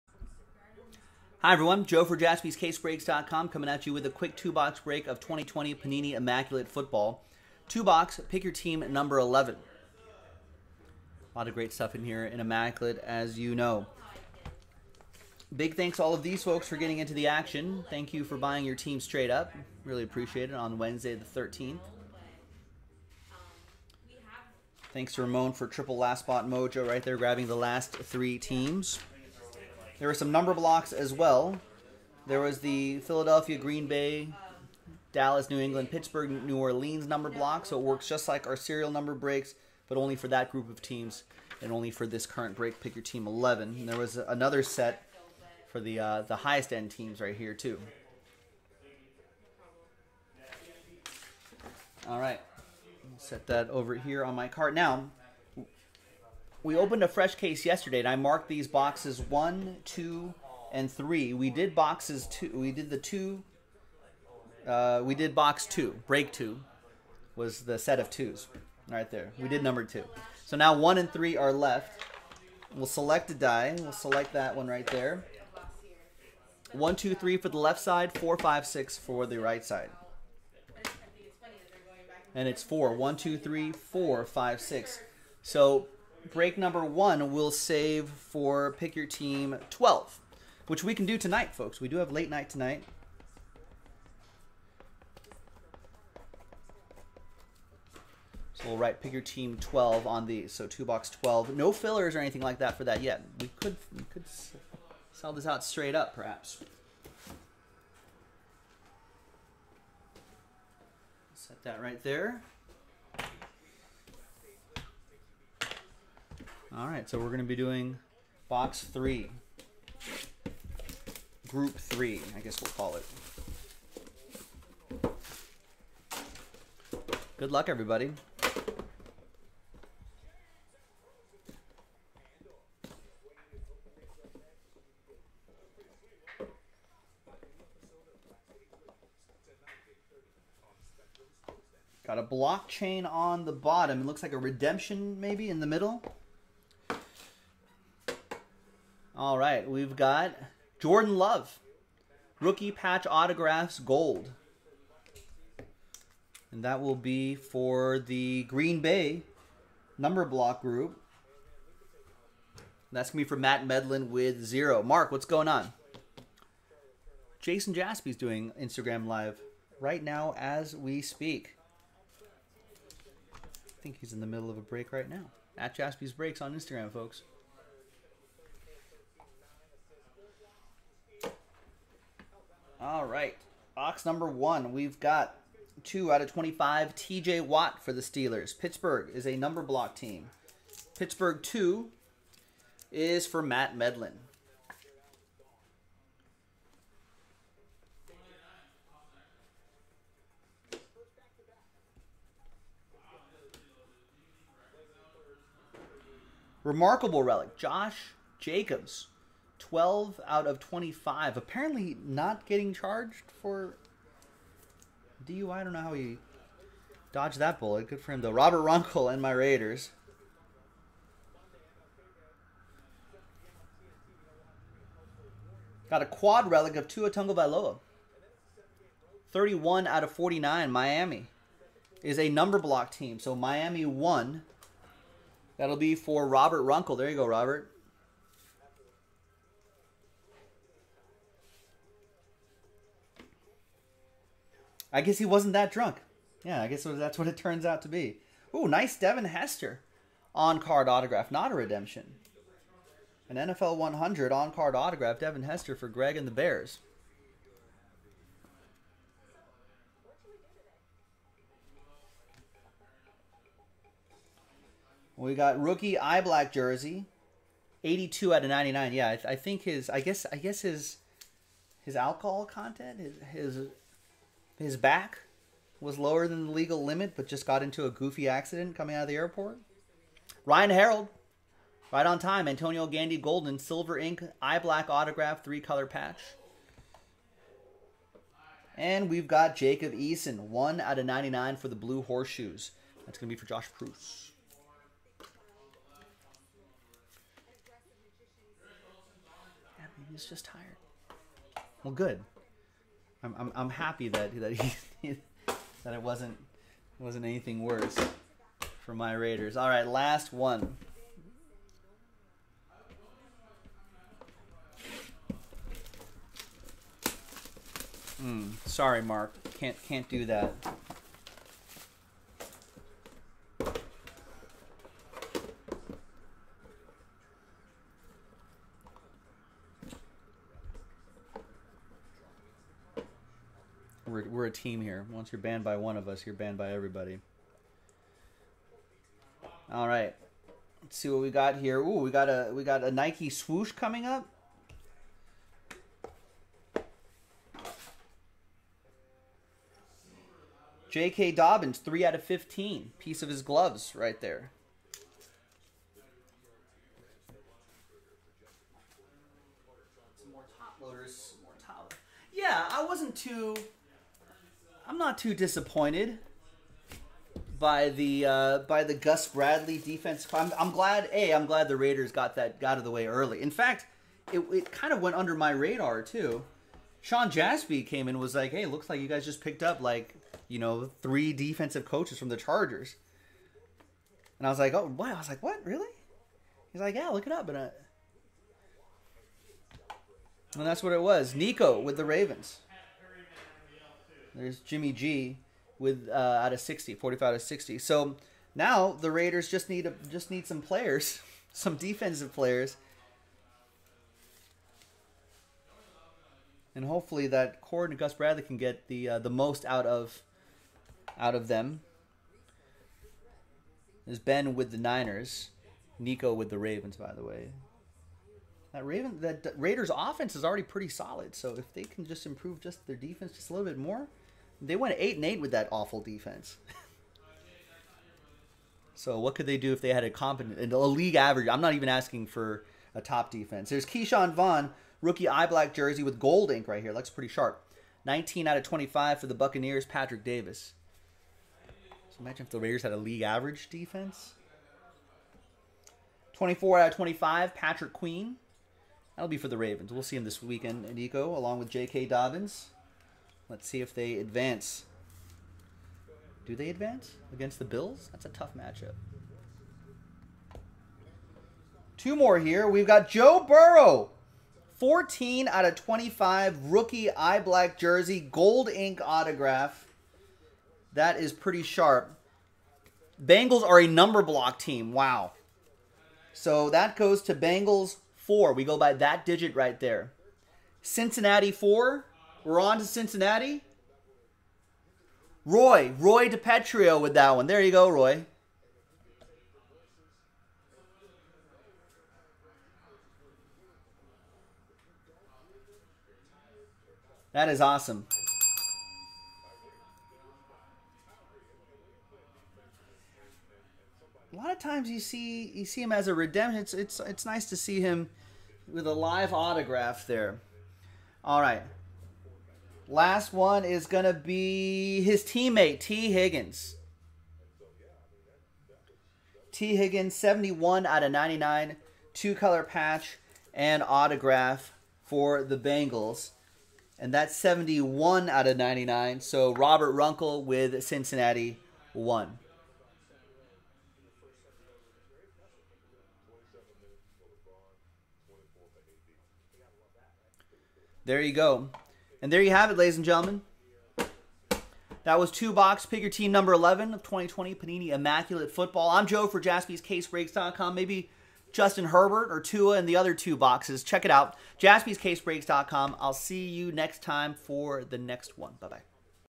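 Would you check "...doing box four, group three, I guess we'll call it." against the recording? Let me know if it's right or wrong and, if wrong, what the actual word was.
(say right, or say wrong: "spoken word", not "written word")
wrong: "three", not "four".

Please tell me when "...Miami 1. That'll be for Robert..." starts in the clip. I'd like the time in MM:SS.
03:53.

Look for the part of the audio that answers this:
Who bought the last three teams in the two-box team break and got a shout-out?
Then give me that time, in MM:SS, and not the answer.
00:25.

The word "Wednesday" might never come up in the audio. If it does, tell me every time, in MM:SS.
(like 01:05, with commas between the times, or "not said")
00:20.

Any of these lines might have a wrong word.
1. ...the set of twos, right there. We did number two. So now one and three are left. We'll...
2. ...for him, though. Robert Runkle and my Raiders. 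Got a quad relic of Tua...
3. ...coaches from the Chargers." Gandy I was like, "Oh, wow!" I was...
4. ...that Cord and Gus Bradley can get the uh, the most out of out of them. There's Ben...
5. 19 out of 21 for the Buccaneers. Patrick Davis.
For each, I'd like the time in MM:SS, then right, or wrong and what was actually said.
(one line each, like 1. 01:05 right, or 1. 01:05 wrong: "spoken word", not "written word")
1. 01:07 right
2. 03:38 right
3. 06:21 wrong: "And", not "Gandy"
4. 06:47 right
5. 07:18 wrong: "25", not "21".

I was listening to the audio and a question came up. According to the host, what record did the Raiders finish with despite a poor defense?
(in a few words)
8 and 8.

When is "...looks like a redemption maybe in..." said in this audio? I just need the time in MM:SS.
02:24.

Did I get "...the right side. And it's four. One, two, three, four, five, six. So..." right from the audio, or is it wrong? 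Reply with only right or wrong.
right.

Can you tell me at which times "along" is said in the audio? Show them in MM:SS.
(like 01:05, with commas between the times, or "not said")
07:31.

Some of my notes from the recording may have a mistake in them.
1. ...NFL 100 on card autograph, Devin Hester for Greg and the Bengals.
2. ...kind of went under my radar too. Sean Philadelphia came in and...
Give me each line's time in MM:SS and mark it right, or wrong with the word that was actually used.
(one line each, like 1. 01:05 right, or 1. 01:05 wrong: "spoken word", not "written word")
1. 04:13 wrong: "Bears", not "Bengals"
2. 06:14 wrong: "Jaspy", not "Philadelphia".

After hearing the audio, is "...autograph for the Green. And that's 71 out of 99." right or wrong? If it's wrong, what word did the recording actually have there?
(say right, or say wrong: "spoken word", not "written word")
wrong: "Bengals", not "Green".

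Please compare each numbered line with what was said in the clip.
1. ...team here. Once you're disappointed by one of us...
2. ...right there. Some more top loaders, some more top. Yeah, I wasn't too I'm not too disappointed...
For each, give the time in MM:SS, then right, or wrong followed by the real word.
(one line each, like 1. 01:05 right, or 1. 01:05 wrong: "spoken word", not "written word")
1. 05:34 wrong: "banned", not "disappointed"
2. 05:53 right.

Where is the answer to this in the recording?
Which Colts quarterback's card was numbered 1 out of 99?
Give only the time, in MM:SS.
04:49.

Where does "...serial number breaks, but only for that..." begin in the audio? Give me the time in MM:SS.
00:38.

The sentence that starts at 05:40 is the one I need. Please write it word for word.
Let's see what we got here.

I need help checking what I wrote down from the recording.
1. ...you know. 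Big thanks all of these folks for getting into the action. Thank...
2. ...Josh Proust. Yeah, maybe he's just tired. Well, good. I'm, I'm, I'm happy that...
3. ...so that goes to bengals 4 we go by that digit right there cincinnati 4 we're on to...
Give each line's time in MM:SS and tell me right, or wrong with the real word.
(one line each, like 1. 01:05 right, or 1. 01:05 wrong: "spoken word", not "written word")
1. 00:13 right
2. 04:53 right
3. 07:56 right.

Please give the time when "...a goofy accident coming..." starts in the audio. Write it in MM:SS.
04:37.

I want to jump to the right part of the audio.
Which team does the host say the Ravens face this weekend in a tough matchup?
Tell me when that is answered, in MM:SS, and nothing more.
07:37.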